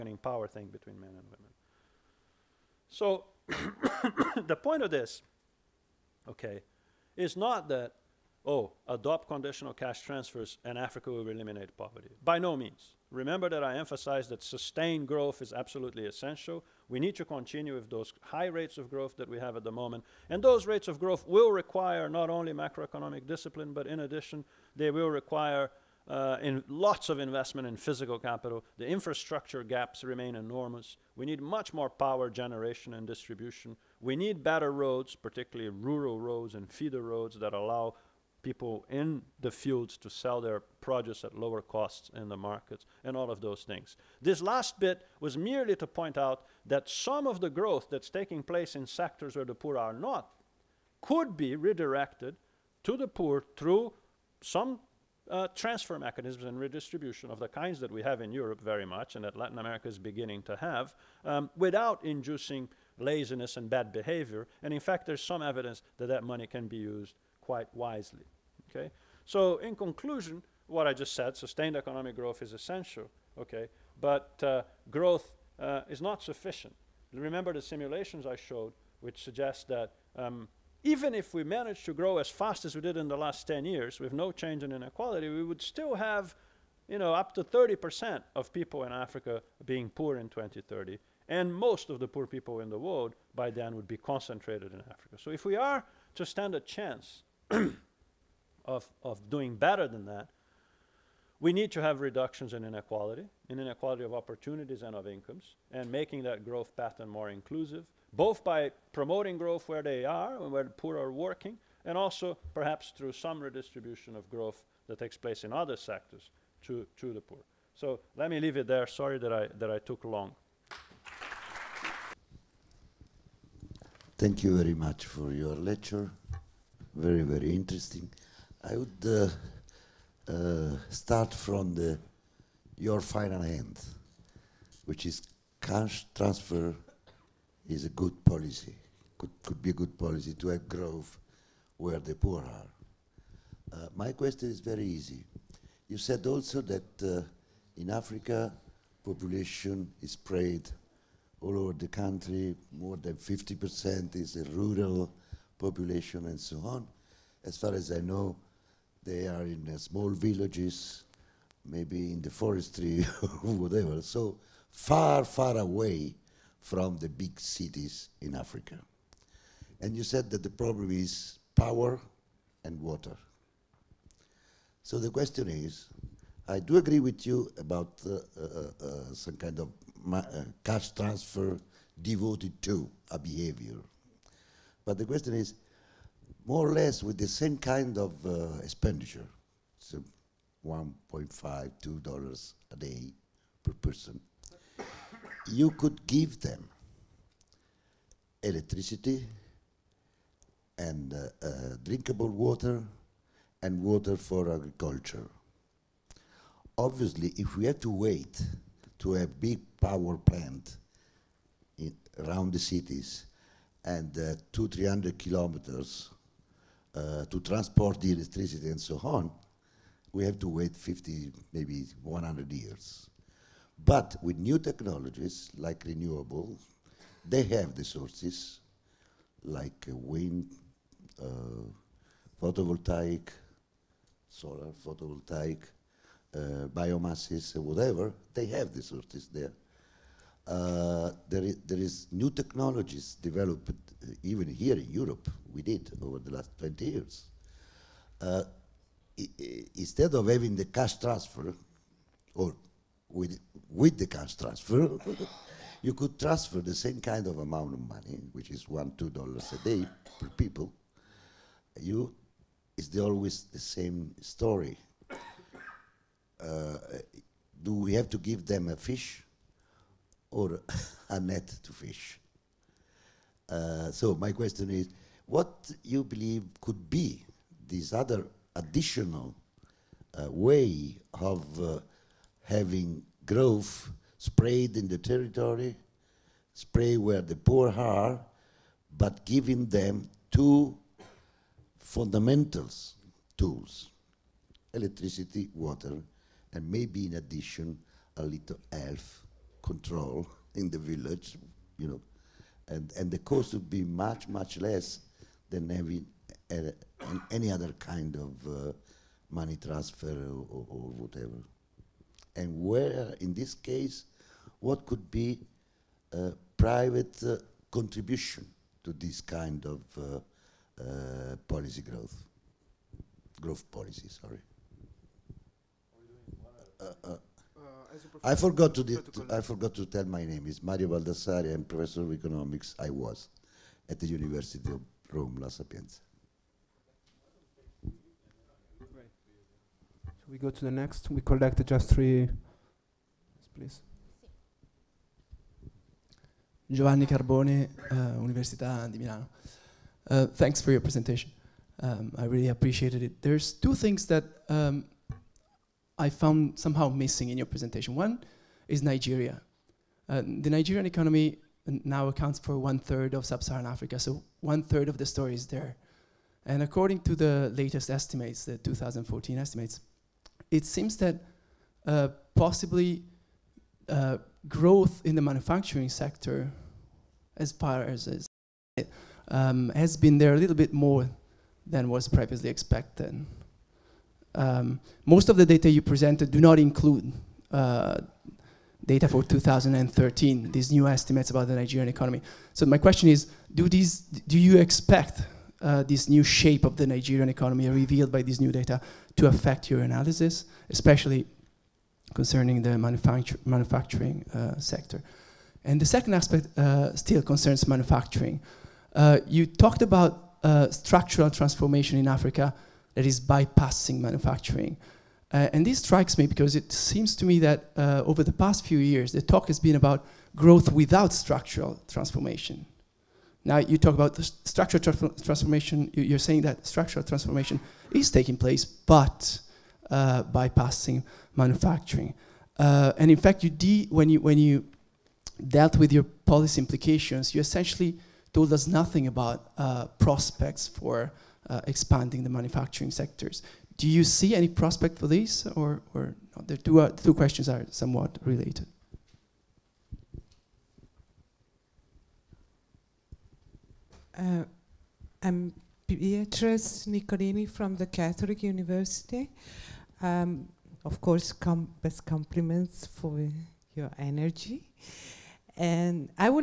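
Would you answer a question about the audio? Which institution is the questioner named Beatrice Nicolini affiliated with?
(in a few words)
Catholic University.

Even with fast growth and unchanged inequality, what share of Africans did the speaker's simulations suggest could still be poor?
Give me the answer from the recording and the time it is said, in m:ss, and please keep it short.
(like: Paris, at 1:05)
30%, at 1:27.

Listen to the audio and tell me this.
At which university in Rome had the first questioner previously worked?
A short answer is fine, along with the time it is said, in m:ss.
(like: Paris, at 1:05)
La Sapienza, at 5:35.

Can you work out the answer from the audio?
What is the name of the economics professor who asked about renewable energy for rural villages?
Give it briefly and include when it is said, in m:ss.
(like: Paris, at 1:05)
Mario Baldassarri, at 5:30.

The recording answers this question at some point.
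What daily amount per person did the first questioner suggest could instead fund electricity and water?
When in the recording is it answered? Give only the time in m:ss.
3:10.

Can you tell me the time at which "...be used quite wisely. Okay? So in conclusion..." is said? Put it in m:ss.
1:06.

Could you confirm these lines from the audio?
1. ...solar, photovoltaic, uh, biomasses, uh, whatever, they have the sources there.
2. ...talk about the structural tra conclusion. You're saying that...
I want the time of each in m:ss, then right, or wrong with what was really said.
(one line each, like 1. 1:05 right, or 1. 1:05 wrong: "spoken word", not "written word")
1. 3:54 right
2. 7:03 wrong: "transformation", not "conclusion".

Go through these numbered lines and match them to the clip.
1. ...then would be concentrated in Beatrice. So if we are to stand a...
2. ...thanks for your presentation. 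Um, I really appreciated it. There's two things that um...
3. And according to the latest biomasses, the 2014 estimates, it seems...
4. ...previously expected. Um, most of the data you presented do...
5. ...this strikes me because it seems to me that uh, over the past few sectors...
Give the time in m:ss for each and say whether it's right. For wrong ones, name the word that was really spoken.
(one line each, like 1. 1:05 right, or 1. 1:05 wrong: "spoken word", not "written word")
1. 1:33 wrong: "Africa", not "Beatrice"
2. 5:50 right
3. 6:06 wrong: "estimates", not "biomasses"
4. 6:22 right
5. 6:55 wrong: "years", not "sectors".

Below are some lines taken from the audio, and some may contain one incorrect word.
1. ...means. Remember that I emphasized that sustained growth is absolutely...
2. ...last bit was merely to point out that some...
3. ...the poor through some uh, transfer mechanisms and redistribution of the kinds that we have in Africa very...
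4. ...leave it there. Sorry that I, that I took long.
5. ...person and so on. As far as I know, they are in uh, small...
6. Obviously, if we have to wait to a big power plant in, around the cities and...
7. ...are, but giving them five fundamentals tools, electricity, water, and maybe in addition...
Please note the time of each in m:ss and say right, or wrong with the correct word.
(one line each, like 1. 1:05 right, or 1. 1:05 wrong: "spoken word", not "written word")
1. 0:12 right
2. 0:44 right
3. 0:52 wrong: "Europe", not "Africa"
4. 1:58 right
5. 2:35 wrong: "population", not "person"
6. 3:26 right
7. 4:47 wrong: "two", not "five".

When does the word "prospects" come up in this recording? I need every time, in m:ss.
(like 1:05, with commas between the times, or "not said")
7:19, 7:24.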